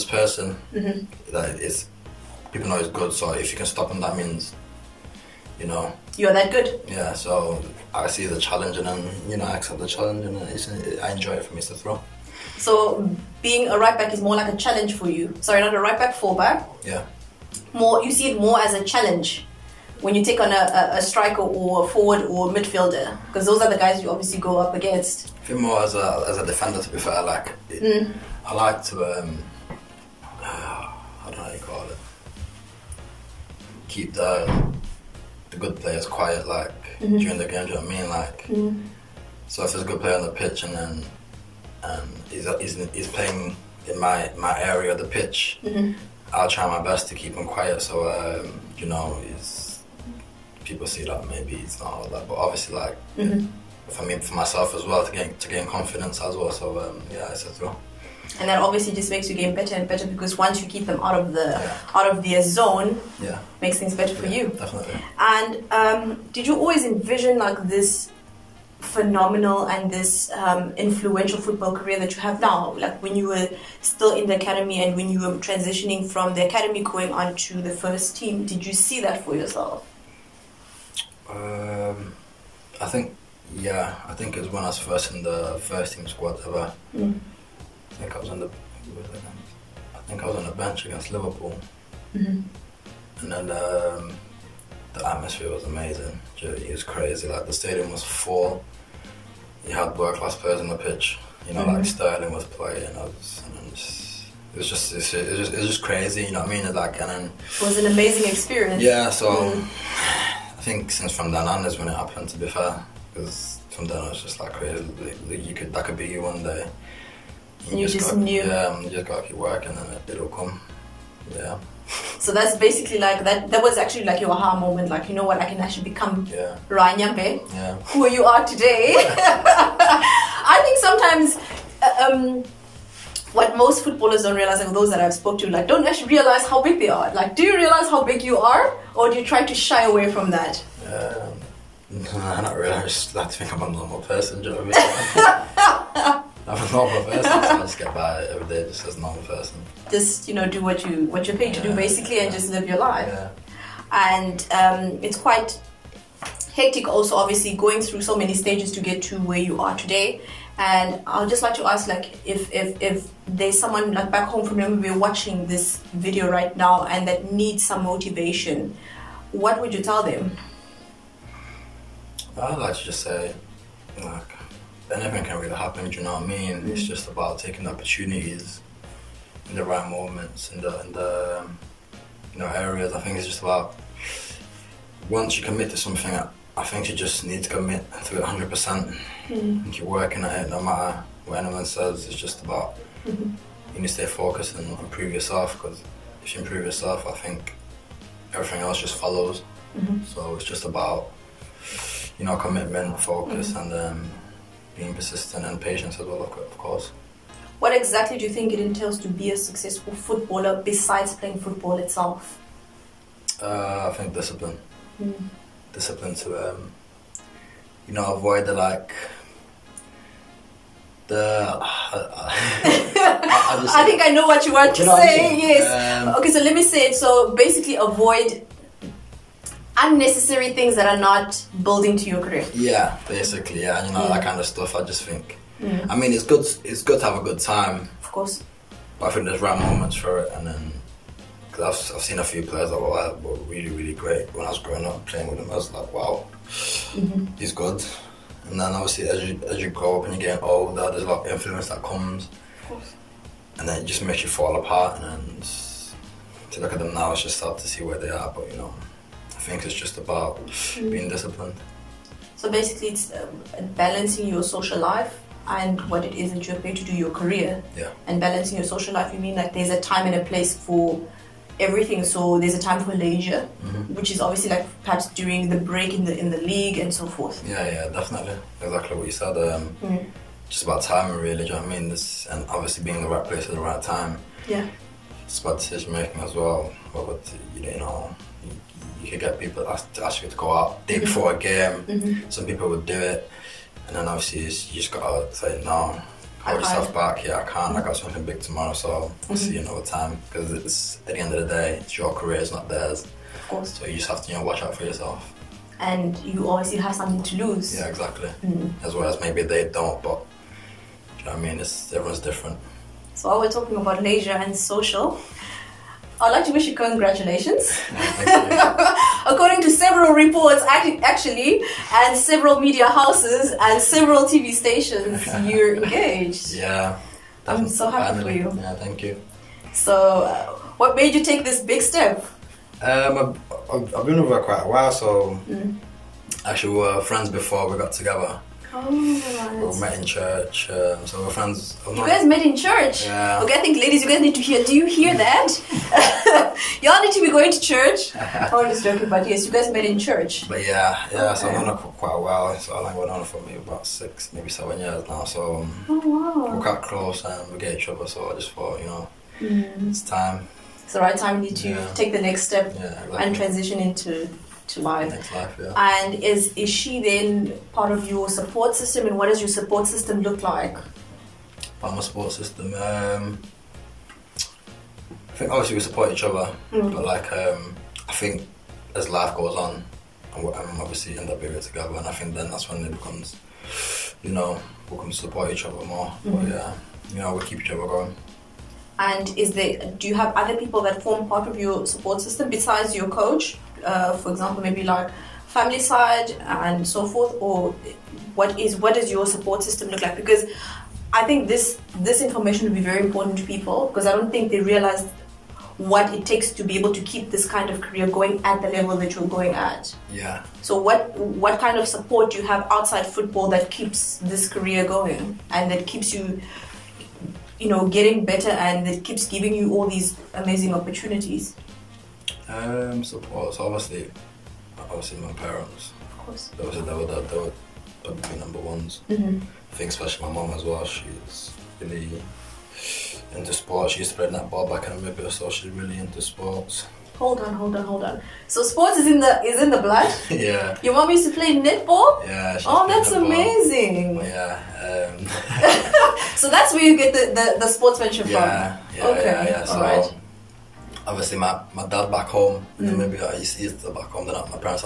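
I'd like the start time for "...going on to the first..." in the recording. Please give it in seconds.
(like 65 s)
76 s.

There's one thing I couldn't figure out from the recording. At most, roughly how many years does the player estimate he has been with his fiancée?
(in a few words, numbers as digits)
7.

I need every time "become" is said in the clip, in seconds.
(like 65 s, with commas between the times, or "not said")
125 s, 382 s.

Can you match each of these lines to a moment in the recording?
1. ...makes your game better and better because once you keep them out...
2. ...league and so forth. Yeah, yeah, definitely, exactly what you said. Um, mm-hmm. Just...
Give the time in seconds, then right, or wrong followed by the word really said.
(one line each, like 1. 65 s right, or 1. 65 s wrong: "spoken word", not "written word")
1. 59 s right
2. 276 s right.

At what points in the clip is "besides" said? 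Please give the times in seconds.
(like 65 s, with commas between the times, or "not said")
210 s, 392 s.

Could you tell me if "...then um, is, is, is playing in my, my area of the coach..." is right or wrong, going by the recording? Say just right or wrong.
wrong.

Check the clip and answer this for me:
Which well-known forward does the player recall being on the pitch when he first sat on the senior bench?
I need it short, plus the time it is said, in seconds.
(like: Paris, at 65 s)
Sterling, at 101 s.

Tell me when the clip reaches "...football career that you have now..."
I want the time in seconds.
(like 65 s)
71 s.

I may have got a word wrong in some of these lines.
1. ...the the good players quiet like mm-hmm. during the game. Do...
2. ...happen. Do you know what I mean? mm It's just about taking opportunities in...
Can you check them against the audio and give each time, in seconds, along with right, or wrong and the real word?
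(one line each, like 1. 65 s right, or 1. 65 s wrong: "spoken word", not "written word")
1. 34 s right
2. 175 s right.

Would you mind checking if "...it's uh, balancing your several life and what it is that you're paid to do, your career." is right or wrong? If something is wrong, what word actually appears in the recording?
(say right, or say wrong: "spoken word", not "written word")
wrong: "social", not "several".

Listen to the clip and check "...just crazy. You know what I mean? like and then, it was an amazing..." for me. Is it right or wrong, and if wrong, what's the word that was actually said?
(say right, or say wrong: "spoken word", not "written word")
right.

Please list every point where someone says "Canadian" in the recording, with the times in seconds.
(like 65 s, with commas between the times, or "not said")
not said.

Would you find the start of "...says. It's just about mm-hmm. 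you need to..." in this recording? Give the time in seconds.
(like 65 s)
191 s.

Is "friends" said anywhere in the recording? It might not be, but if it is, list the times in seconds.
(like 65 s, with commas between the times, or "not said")
337 s, 341 s.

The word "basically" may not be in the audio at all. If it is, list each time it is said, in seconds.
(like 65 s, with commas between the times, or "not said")
122 s, 151 s, 227 s, 233 s, 262 s.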